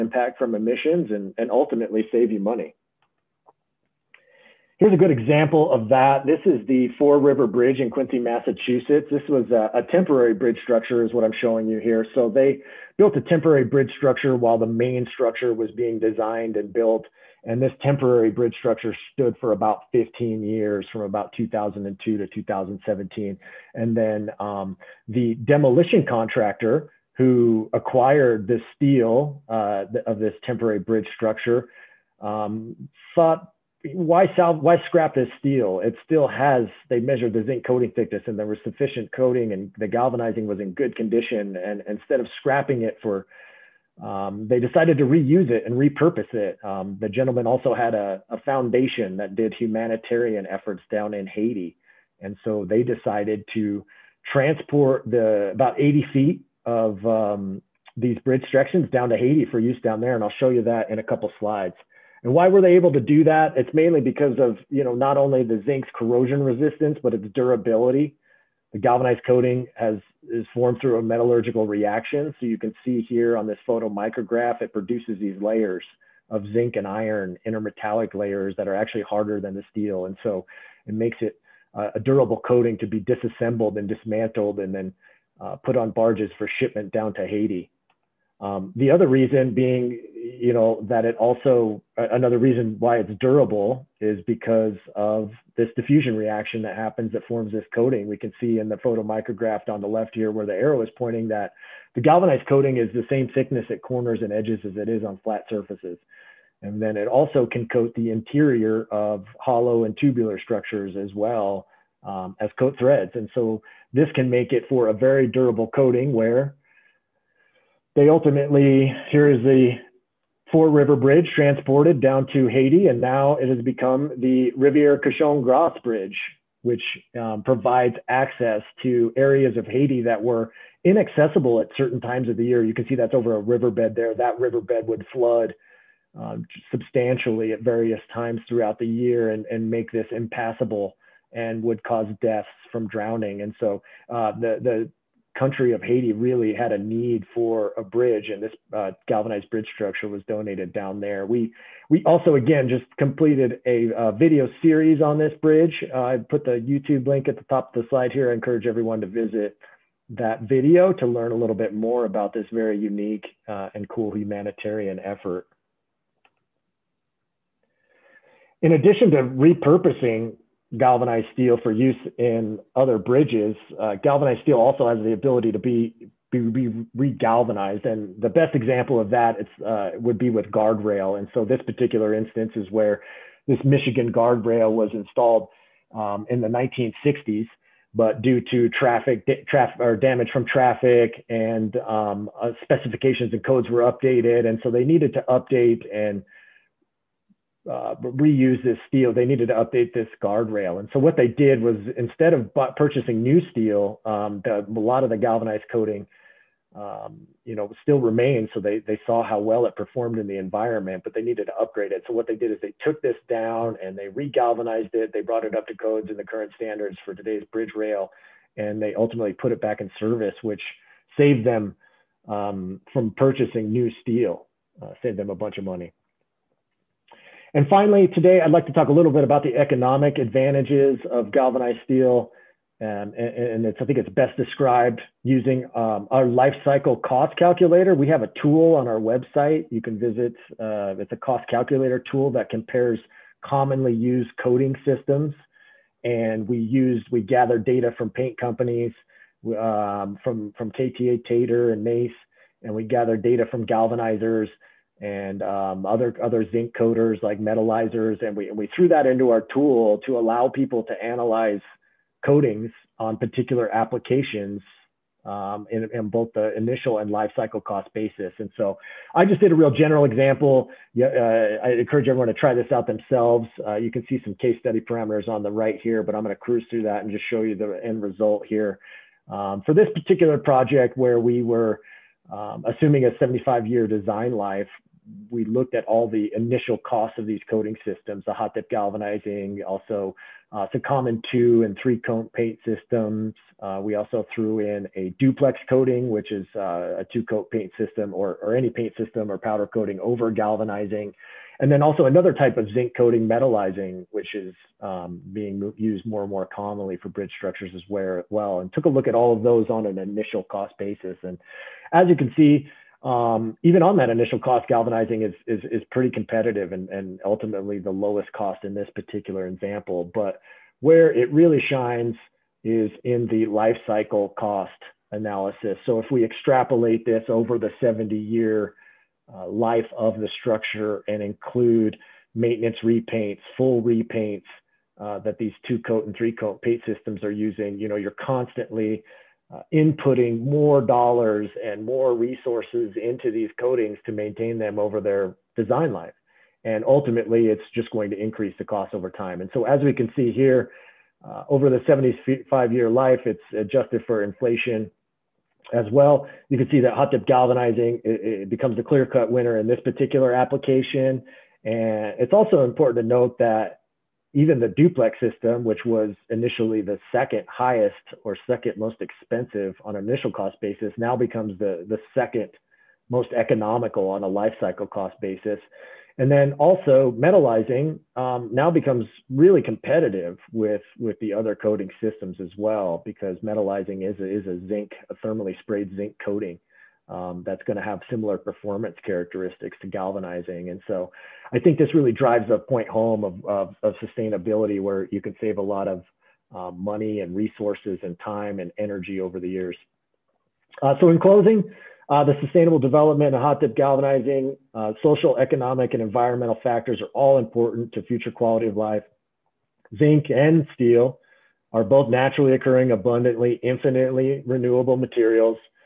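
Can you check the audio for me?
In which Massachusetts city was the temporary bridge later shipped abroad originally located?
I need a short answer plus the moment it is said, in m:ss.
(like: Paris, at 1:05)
Quincy, at 0:07.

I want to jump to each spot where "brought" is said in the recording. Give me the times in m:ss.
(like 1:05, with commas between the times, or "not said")
3:35.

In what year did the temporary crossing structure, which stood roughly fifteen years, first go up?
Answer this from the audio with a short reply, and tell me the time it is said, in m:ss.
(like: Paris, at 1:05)
2002, at 0:21.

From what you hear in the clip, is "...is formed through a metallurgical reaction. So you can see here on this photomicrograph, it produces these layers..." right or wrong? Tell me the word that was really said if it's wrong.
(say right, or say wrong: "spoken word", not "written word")
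right.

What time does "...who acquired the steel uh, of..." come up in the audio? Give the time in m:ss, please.
0:27.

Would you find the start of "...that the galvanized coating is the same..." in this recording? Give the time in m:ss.
1:41.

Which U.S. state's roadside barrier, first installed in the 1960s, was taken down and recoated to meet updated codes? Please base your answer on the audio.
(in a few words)
Michigan.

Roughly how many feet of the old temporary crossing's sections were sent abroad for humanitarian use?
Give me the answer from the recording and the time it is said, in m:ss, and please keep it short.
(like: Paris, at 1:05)
80 feet, at 0:55.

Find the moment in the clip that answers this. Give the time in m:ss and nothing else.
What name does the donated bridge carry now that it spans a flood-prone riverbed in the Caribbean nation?
2:04.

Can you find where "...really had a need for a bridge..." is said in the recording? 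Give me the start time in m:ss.
2:26.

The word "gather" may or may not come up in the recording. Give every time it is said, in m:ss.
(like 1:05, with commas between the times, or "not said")
4:07, 4:12.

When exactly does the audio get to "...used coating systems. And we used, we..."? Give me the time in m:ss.
4:03.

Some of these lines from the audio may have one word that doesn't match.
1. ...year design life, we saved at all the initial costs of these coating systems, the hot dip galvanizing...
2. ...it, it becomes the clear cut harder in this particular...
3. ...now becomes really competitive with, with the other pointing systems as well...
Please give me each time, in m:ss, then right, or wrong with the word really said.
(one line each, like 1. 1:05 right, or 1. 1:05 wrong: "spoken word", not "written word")
1. 4:43 wrong: "looked", not "saved"
2. 5:58 wrong: "winner", not "harder"
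3. 6:18 wrong: "coating", not "pointing".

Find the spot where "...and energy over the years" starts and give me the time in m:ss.
6:38.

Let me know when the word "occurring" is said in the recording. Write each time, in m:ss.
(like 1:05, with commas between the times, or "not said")
6:52.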